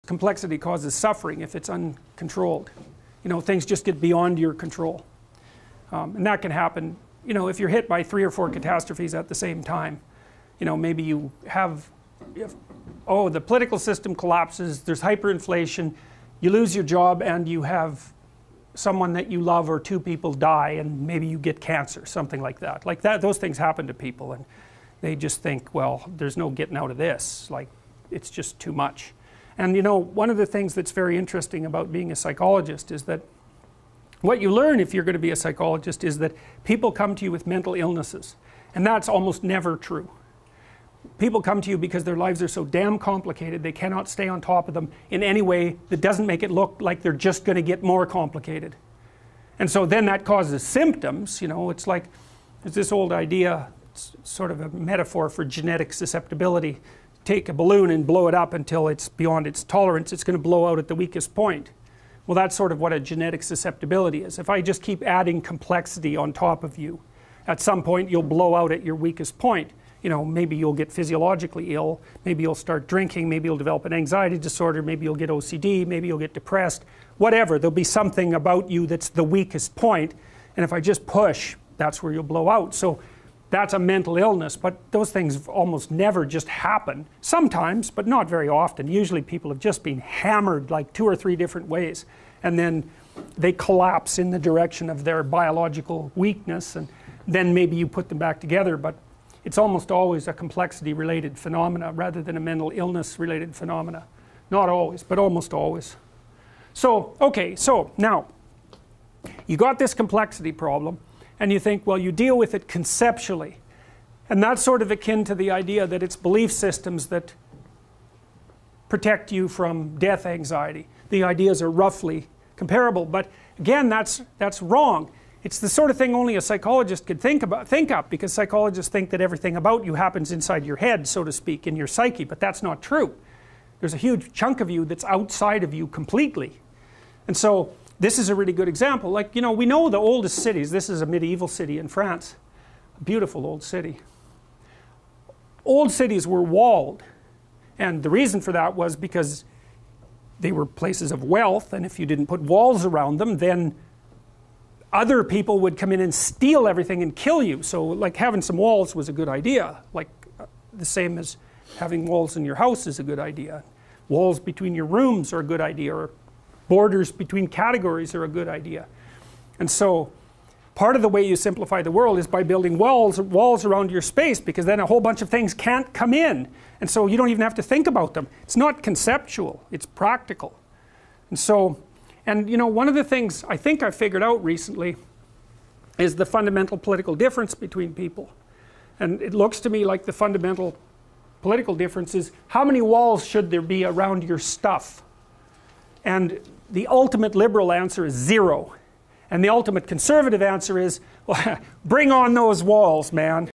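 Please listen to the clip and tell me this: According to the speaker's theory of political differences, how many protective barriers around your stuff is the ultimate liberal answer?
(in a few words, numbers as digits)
0.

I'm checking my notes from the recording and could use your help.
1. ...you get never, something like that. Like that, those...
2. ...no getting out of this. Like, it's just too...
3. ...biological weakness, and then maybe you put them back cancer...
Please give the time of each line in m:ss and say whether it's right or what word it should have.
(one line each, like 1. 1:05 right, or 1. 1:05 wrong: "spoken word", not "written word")
1. 0:21 wrong: "cancer", not "never"
2. 0:26 right
3. 1:35 wrong: "together", not "cancer".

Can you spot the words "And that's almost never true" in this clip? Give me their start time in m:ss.
0:38.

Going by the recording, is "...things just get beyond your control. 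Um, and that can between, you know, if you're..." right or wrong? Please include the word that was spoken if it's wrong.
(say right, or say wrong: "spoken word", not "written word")
wrong: "happen", not "between".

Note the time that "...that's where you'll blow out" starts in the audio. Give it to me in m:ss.
1:21.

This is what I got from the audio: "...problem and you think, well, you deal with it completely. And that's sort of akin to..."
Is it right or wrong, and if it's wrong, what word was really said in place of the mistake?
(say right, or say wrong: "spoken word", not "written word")
wrong: "conceptually", not "completely".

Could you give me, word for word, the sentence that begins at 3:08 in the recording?
And it looks to me like the fundamental political difference is how many walls should there be around your stuff?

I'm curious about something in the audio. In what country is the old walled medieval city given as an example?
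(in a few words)
France.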